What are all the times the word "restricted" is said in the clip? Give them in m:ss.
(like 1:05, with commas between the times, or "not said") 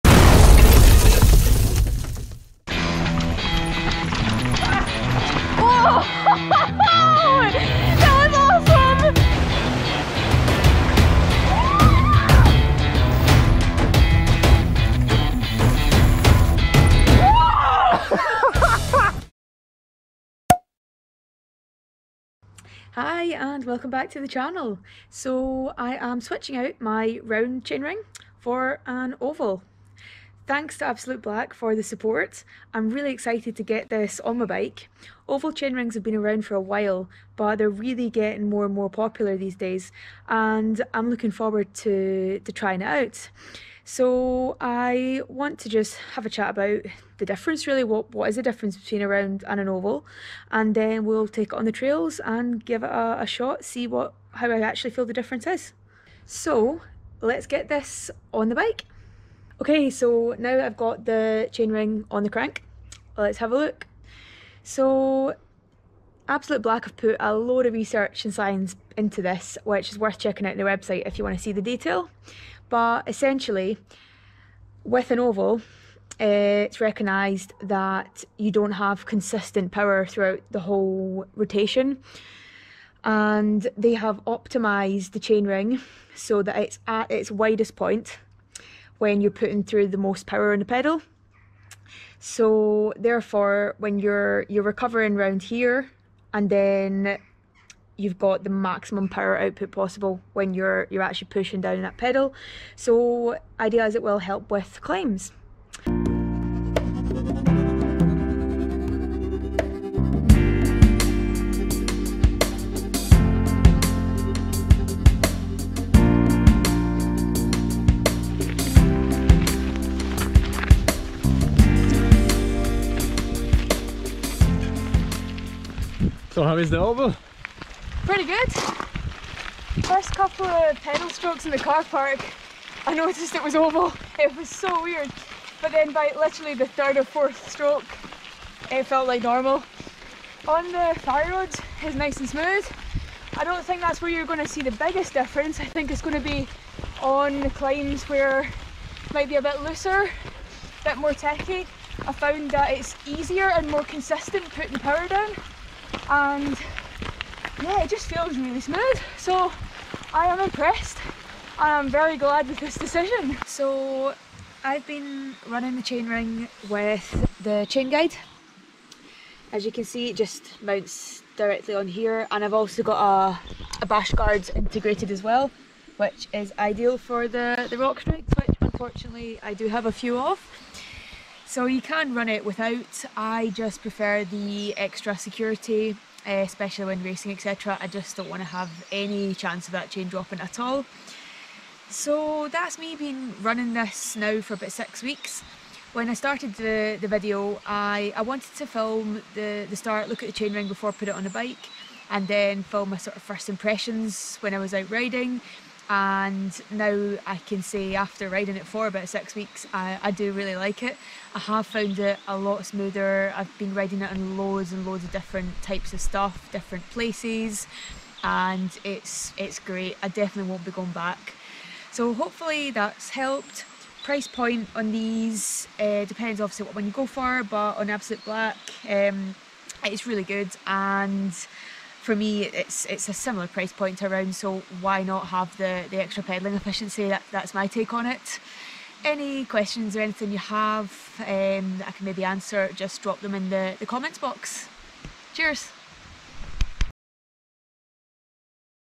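not said.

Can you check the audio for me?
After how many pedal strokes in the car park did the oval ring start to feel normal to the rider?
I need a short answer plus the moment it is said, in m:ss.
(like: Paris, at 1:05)
3 or 4, at 2:16.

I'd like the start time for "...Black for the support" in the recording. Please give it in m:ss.
0:31.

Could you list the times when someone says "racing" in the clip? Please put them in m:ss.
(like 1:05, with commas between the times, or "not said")
3:07.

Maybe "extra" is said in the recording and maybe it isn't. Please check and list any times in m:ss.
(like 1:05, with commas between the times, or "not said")
3:04, 3:56.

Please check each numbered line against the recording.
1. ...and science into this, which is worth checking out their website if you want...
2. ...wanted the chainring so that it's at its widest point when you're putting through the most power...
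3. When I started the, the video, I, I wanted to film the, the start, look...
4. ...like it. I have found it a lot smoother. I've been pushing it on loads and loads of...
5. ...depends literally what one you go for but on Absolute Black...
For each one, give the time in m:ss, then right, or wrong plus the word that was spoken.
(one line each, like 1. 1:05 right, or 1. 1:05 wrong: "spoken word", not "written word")
1. 1:08 right
2. 1:24 wrong: "optimised", not "wanted"
3. 3:15 right
4. 3:30 wrong: "riding", not "pushing"
5. 3:46 wrong: "obviously", not "literally".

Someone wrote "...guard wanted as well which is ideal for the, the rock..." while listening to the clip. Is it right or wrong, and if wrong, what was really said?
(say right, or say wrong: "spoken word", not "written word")
wrong: "integrated", not "wanted".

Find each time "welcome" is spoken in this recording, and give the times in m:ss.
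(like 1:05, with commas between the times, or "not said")
0:23.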